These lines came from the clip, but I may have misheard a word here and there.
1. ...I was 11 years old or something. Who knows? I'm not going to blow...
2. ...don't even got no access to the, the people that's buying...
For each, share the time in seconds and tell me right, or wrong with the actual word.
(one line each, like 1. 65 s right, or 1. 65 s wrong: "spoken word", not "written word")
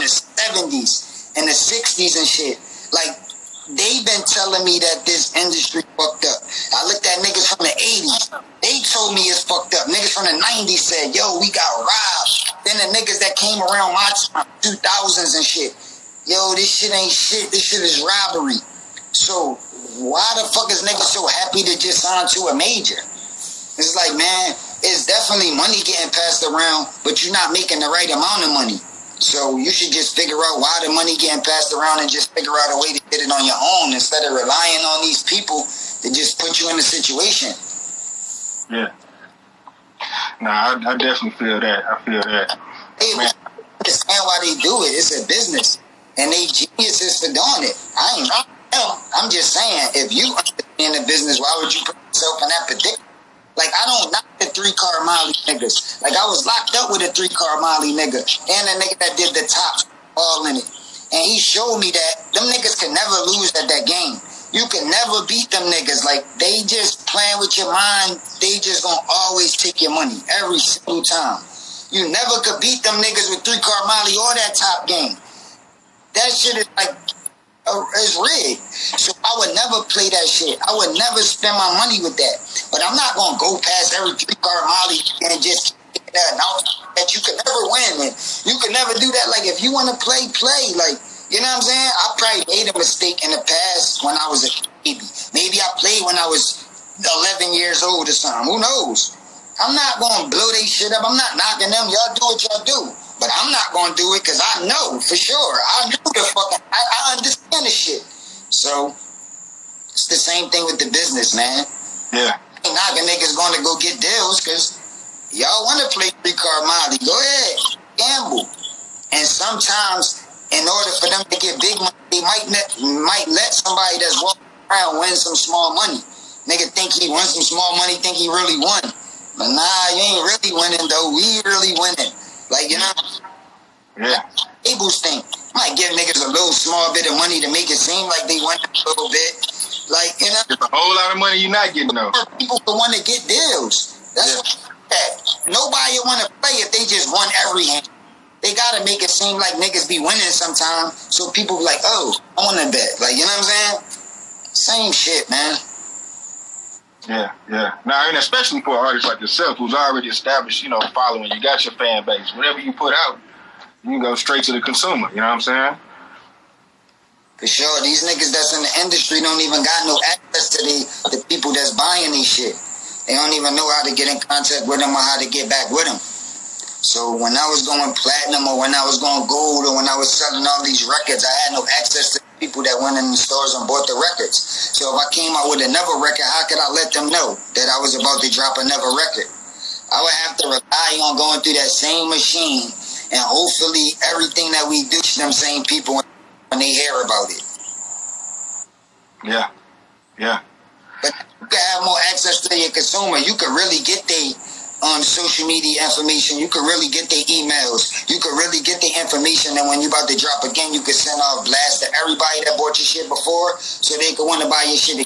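1. 96 s right
2. 169 s right.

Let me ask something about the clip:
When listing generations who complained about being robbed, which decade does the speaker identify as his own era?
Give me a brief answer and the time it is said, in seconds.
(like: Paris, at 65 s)
2000s, at 14 s.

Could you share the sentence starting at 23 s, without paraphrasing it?
It's like, man, it's definitely money getting passed around, but you're not making the right amount of money.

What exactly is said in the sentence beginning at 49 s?
I'm just saying, if you in the business, why would you put yourself in that predicament?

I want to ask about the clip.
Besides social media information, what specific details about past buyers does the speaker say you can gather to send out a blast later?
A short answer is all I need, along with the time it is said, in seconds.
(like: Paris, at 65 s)
emails, at 207 s.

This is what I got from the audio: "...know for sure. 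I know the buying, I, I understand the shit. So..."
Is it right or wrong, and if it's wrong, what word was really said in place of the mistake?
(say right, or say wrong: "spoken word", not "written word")
wrong: "fucking", not "buying".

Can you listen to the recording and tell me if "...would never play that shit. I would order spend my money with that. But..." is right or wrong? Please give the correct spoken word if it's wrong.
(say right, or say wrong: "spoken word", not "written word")
wrong: "never", not "order".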